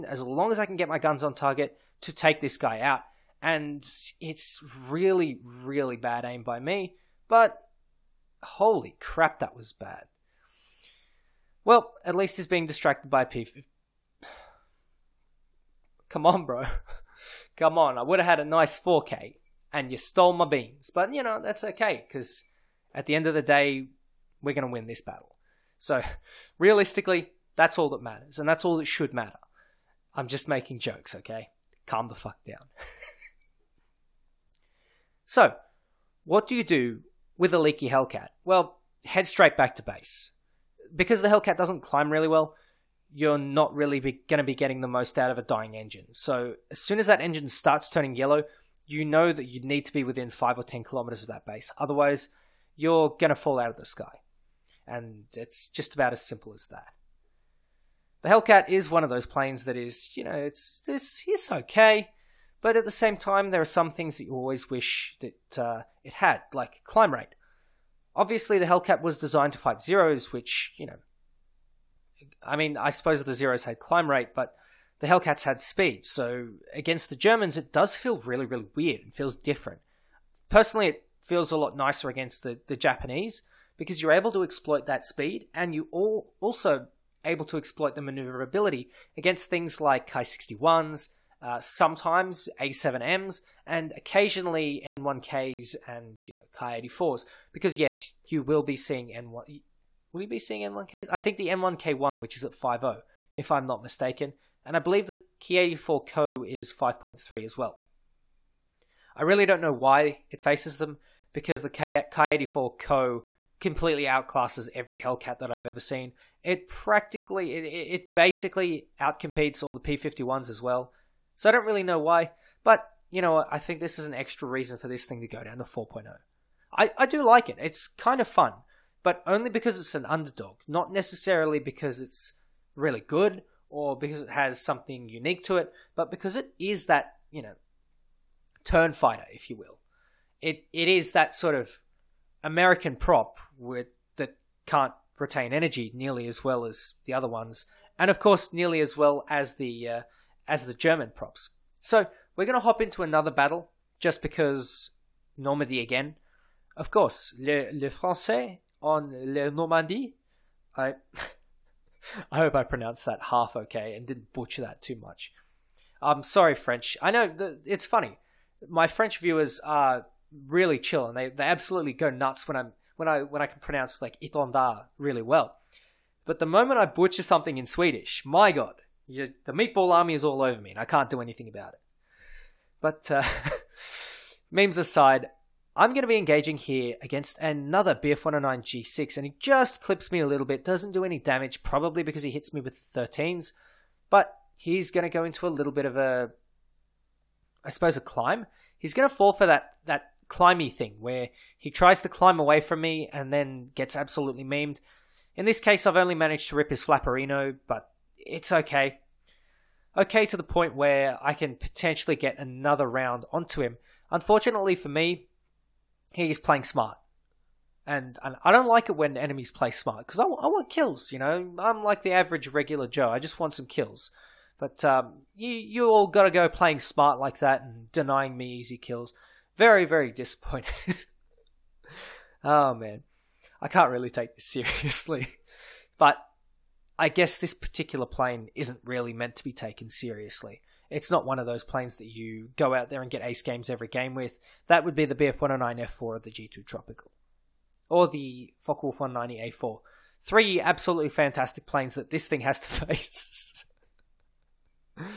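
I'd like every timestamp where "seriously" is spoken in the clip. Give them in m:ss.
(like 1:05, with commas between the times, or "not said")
3:54, 3:59.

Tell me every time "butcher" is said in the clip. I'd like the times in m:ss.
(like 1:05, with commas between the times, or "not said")
2:44, 2:56.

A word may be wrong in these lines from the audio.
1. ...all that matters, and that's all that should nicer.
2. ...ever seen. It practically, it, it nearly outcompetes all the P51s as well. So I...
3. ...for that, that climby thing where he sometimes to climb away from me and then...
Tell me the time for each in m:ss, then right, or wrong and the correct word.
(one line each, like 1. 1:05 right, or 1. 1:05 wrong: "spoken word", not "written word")
1. 0:27 wrong: "matter", not "nicer"
2. 1:55 wrong: "basically", not "nearly"
3. 3:19 wrong: "tries", not "sometimes".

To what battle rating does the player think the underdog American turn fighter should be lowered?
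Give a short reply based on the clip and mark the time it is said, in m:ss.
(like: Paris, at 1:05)
4.0, at 2:05.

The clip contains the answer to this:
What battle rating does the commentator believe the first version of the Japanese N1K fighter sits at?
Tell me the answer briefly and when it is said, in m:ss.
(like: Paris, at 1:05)
5.0, at 1:42.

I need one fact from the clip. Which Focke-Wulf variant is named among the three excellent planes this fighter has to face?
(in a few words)
190A4.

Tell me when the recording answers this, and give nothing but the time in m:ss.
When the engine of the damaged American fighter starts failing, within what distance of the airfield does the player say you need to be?
0:50.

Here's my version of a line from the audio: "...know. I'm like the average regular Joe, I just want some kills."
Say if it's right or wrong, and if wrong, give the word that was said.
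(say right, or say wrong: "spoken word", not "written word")
right.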